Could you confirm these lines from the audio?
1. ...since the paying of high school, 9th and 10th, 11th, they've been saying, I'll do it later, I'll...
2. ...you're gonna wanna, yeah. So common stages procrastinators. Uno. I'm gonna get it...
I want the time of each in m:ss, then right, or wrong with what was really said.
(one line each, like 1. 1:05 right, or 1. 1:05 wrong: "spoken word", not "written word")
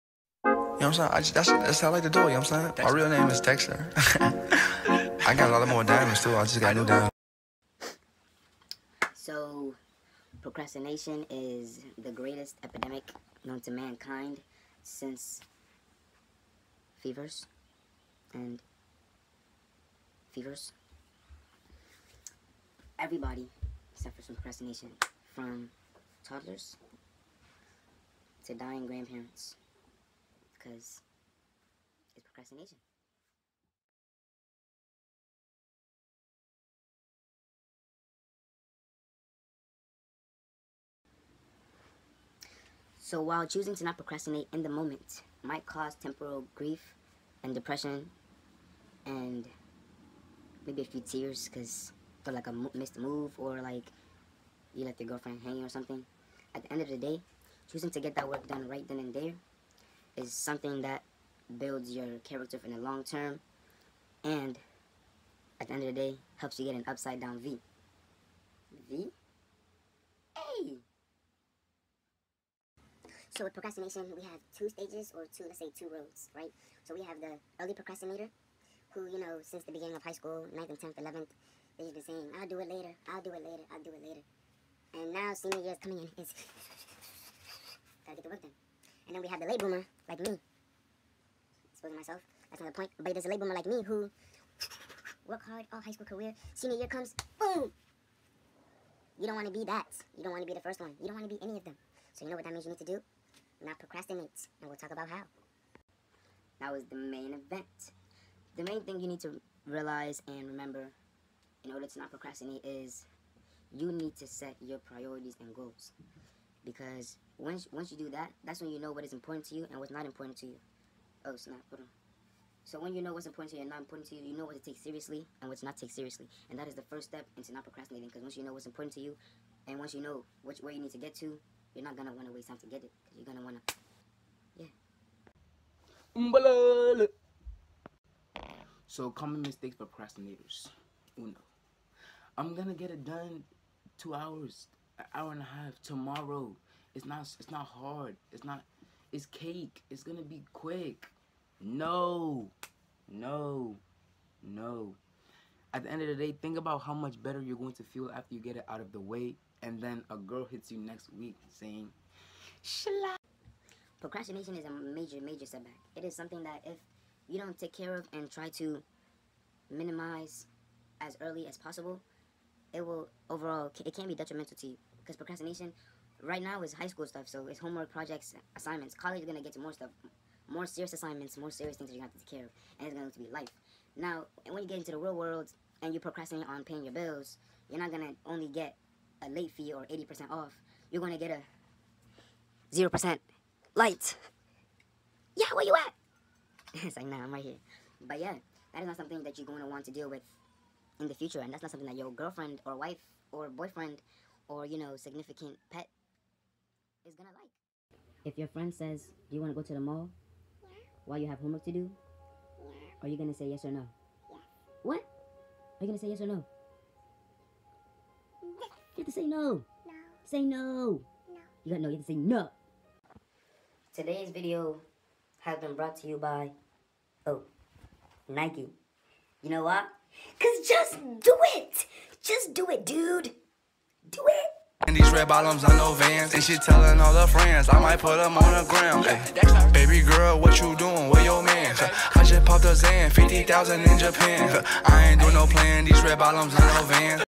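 1. 1:19 wrong: "beginning", not "paying"
2. 2:13 wrong: "mistakes", not "stages".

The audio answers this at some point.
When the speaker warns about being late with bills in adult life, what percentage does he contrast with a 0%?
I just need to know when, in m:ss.
3:09.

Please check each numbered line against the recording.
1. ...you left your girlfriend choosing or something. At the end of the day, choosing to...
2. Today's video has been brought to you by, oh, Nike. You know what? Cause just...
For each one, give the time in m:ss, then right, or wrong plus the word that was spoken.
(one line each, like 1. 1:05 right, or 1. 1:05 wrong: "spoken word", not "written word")
1. 0:54 wrong: "hanging", not "choosing"
2. 3:43 right.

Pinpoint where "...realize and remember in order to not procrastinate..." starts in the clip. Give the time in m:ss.
1:49.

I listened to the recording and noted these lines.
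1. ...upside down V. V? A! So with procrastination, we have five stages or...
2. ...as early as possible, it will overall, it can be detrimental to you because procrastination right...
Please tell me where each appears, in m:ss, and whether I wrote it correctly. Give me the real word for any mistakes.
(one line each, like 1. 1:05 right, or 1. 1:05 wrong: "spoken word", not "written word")
1. 1:06 wrong: "two", not "five"
2. 2:50 right.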